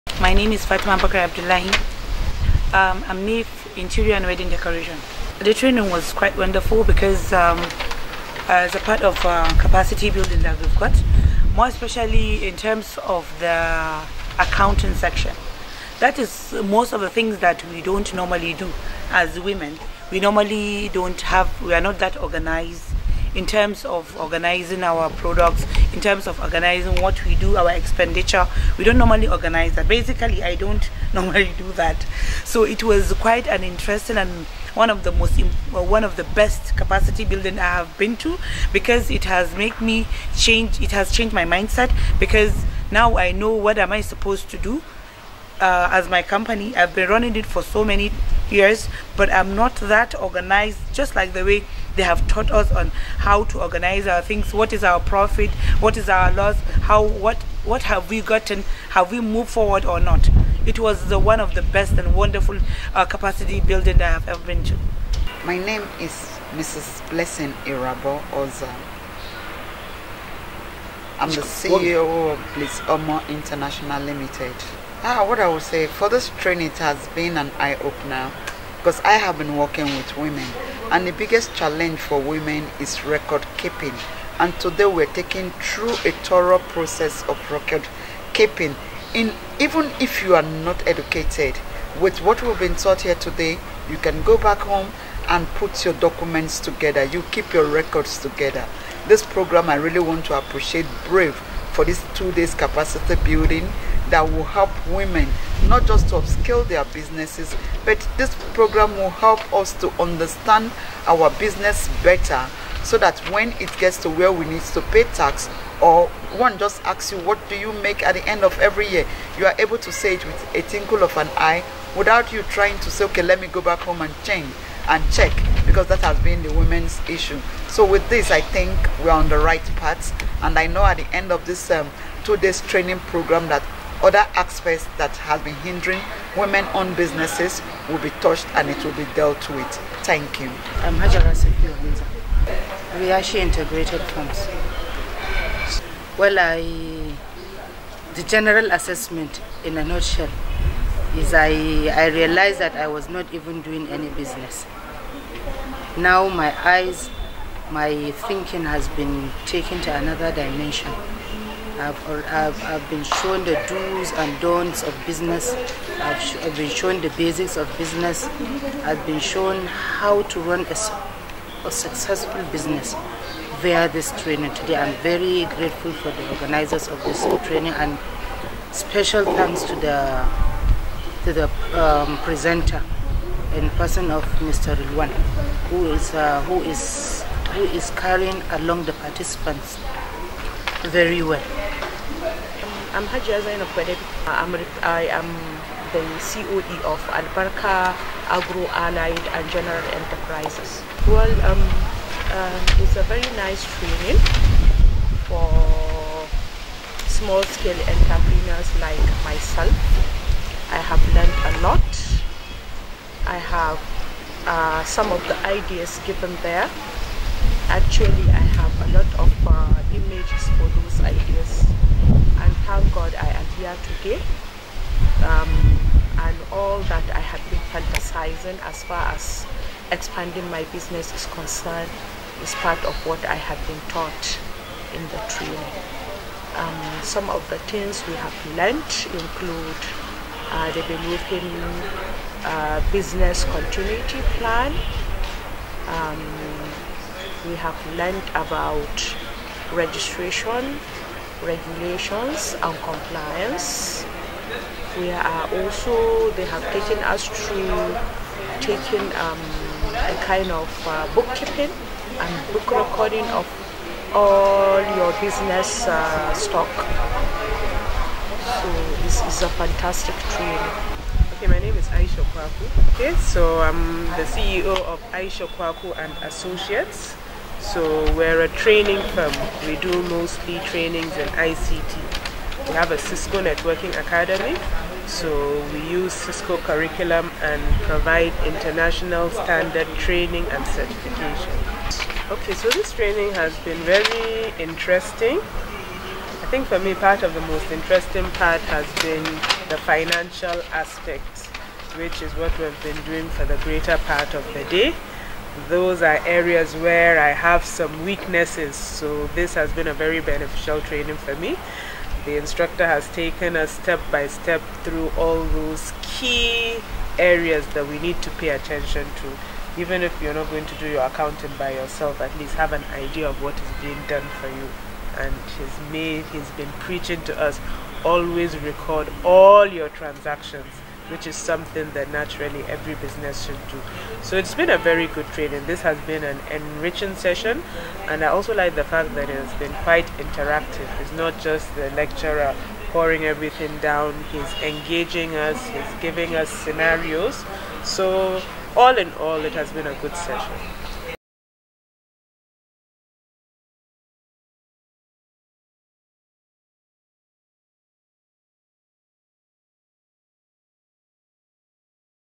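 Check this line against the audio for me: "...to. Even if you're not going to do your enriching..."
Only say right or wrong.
wrong.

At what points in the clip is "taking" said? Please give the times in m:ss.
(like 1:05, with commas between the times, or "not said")
1:25, 4:18.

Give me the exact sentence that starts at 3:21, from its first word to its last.
Well, um, uh, it's a very nice training for small-scale entrepreneurs like myself.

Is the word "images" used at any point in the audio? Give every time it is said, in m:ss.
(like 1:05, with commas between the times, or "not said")
3:39.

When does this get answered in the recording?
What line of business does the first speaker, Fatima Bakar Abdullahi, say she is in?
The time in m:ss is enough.
0:03.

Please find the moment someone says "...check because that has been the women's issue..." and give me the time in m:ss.
2:05.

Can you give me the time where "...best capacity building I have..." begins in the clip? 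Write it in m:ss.
0:36.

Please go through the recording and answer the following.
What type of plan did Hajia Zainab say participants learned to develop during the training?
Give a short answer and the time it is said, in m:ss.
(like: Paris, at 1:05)
Business continuity plan, at 4:02.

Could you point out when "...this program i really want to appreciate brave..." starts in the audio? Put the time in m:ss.
1:39.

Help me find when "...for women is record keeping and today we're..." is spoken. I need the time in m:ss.
1:21.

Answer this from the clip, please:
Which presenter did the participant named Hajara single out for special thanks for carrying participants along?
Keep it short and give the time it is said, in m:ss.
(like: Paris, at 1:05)
Mr. Rilwan, at 3:04.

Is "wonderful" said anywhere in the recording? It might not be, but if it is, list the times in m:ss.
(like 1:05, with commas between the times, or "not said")
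0:06, 1:02.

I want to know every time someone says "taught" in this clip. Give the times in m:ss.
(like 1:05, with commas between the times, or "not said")
0:52, 1:32, 3:53.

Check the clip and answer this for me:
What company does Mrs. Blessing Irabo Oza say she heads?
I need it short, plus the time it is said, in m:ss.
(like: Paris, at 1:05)
Bliss Omo International Limited, at 1:12.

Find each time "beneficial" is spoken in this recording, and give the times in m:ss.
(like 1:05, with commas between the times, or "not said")
5:10.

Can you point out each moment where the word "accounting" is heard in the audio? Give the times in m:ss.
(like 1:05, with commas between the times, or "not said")
0:14, 5:21.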